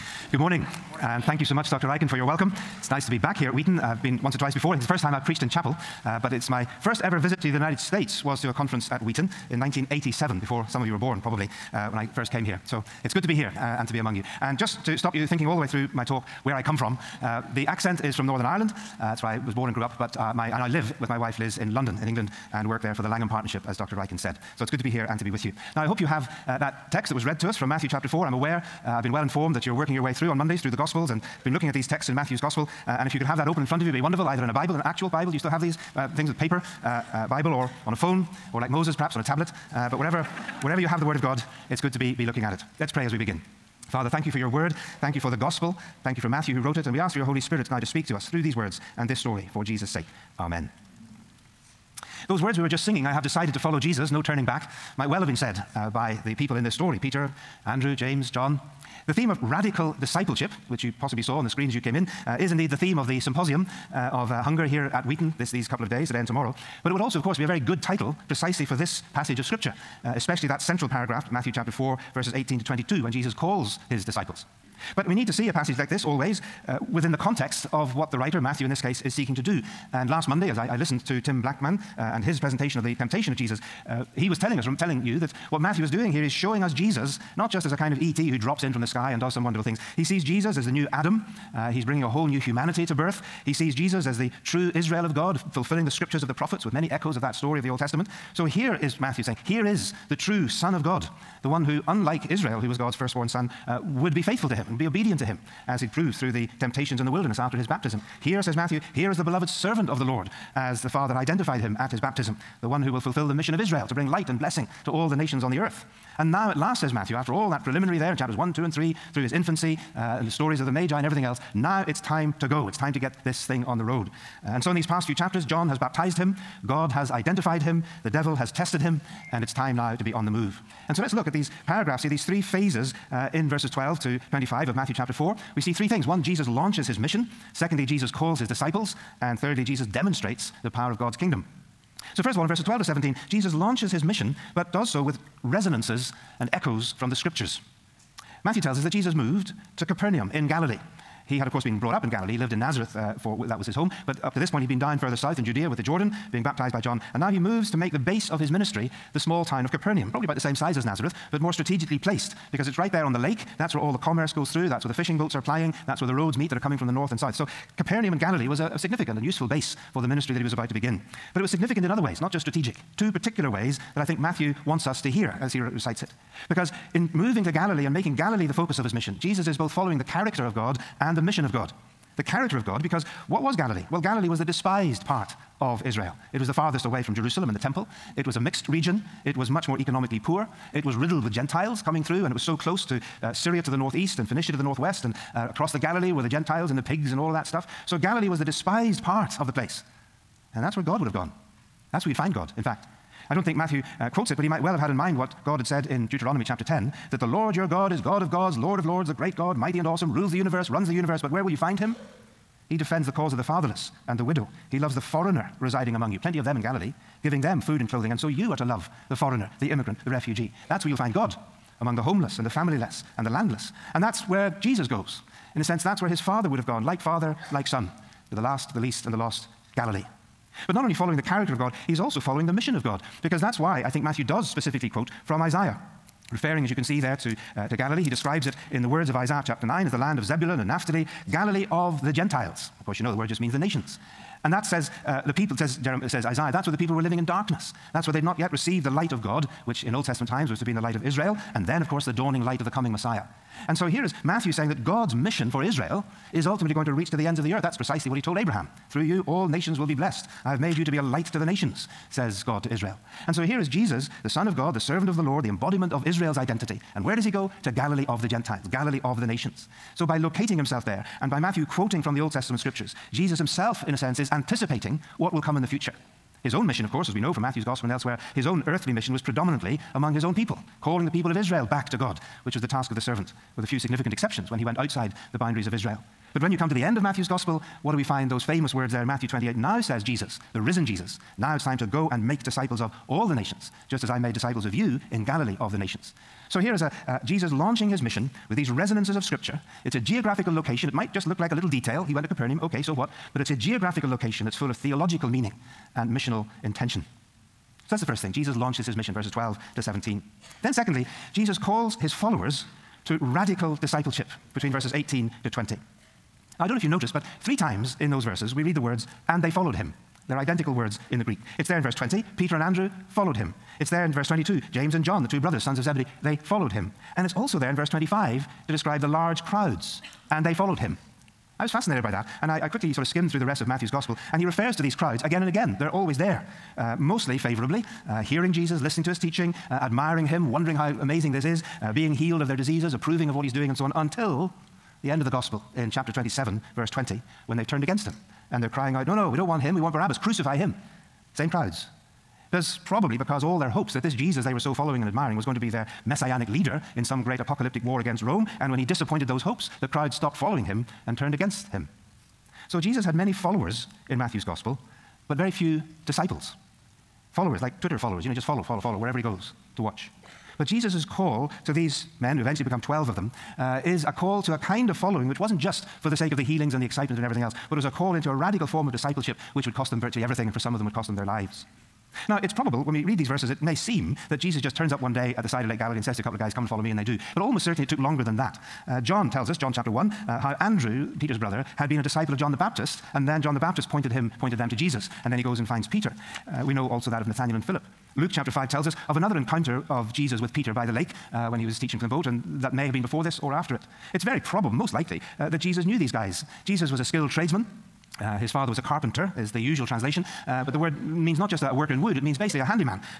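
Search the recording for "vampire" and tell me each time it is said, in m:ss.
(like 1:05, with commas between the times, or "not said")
not said.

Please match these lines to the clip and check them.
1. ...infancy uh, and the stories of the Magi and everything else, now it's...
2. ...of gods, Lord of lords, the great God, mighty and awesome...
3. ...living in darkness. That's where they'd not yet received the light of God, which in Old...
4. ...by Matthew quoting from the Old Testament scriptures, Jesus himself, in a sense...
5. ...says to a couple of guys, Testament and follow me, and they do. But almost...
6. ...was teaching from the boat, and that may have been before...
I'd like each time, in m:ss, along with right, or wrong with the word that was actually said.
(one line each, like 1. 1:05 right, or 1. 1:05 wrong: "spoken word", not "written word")
1. 1:59 right
2. 3:28 right
3. 4:07 right
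4. 4:31 right
5. 6:26 wrong: "Come", not "Testament"
6. 6:41 right.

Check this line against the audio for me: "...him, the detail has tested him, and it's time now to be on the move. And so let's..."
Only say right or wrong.
wrong.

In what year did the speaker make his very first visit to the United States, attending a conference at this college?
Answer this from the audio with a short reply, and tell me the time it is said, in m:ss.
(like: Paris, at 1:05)
1987, at 0:09.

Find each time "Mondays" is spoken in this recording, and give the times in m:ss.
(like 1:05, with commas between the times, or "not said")
0:30, 1:20.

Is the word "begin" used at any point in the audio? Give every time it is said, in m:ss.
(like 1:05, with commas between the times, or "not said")
0:43, 2:50.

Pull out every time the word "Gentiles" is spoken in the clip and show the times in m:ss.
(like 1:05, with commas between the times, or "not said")
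3:11, 3:16, 4:02, 4:28.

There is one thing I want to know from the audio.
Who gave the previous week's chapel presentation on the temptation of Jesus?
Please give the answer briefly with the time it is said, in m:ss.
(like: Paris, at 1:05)
Tim Blackmon, at 1:21.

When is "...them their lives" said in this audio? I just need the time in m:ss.
6:21.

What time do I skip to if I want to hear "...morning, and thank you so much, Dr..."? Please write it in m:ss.
0:00.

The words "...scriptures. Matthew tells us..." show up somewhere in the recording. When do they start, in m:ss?
2:27.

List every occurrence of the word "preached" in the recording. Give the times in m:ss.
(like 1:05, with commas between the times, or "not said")
0:05.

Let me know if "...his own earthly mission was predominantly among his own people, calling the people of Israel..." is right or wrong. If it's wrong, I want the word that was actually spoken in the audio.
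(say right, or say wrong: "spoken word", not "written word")
right.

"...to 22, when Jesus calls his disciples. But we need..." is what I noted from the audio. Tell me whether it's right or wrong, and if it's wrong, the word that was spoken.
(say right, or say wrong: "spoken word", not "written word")
right.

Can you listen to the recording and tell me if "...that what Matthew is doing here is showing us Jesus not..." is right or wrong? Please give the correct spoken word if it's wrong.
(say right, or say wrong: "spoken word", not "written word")
right.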